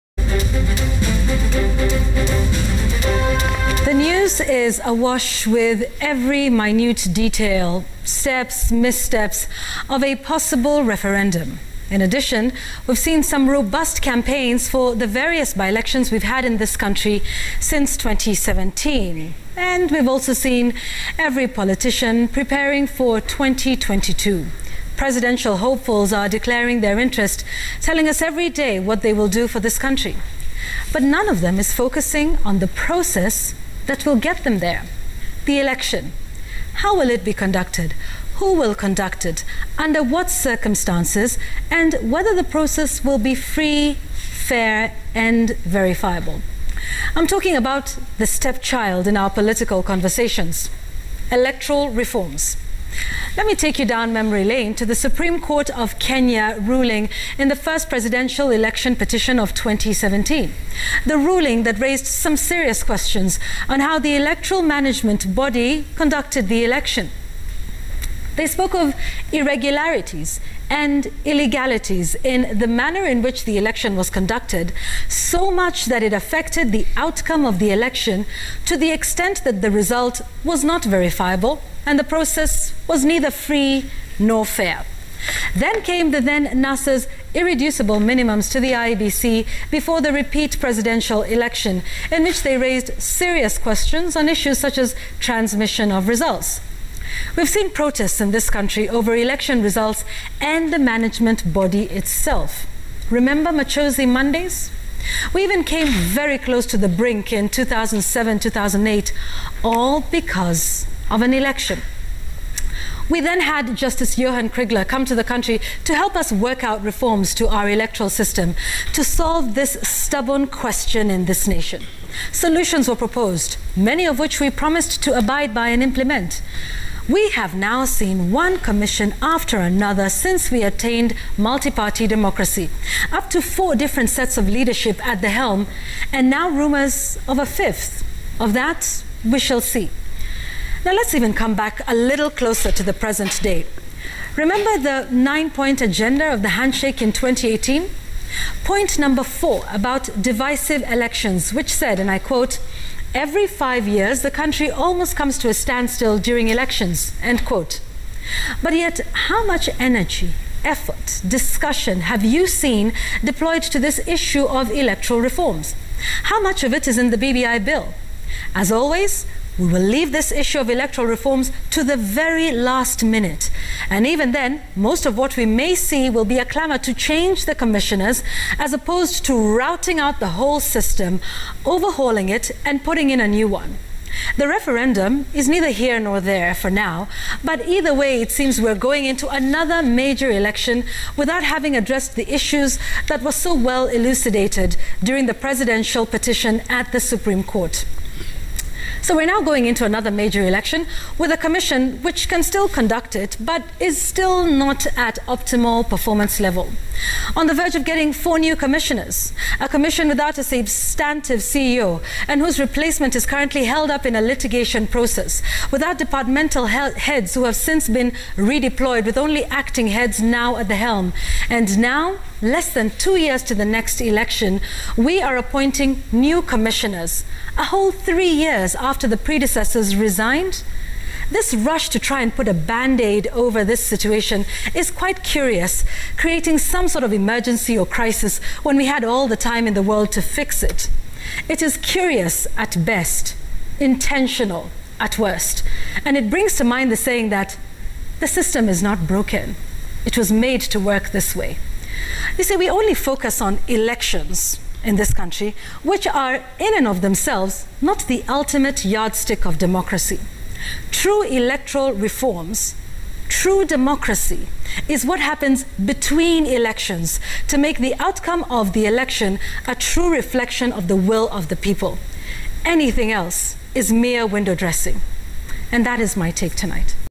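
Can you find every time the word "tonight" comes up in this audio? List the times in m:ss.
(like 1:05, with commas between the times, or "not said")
4:36.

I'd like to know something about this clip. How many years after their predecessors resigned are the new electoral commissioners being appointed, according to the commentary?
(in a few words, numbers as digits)
3.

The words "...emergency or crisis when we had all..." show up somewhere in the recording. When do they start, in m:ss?
3:57.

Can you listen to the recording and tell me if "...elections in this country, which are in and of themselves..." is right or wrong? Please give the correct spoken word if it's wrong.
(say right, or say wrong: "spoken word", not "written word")
right.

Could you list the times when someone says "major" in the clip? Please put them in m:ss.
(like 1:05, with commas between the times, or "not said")
3:09, 3:20.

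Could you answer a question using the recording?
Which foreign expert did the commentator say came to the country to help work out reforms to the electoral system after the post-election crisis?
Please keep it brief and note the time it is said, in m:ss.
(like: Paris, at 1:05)
Johan Kriegler, at 1:54.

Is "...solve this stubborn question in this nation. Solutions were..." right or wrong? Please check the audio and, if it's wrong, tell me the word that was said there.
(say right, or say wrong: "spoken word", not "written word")
right.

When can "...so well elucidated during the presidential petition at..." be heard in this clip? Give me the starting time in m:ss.
3:13.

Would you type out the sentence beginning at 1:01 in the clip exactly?
The ruling that raised some serious questions on how the electoral management body conducted the election.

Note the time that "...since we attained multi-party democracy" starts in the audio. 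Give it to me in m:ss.
2:10.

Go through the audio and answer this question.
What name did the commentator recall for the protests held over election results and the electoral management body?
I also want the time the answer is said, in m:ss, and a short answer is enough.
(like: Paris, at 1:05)
Machozi Mondays, at 1:43.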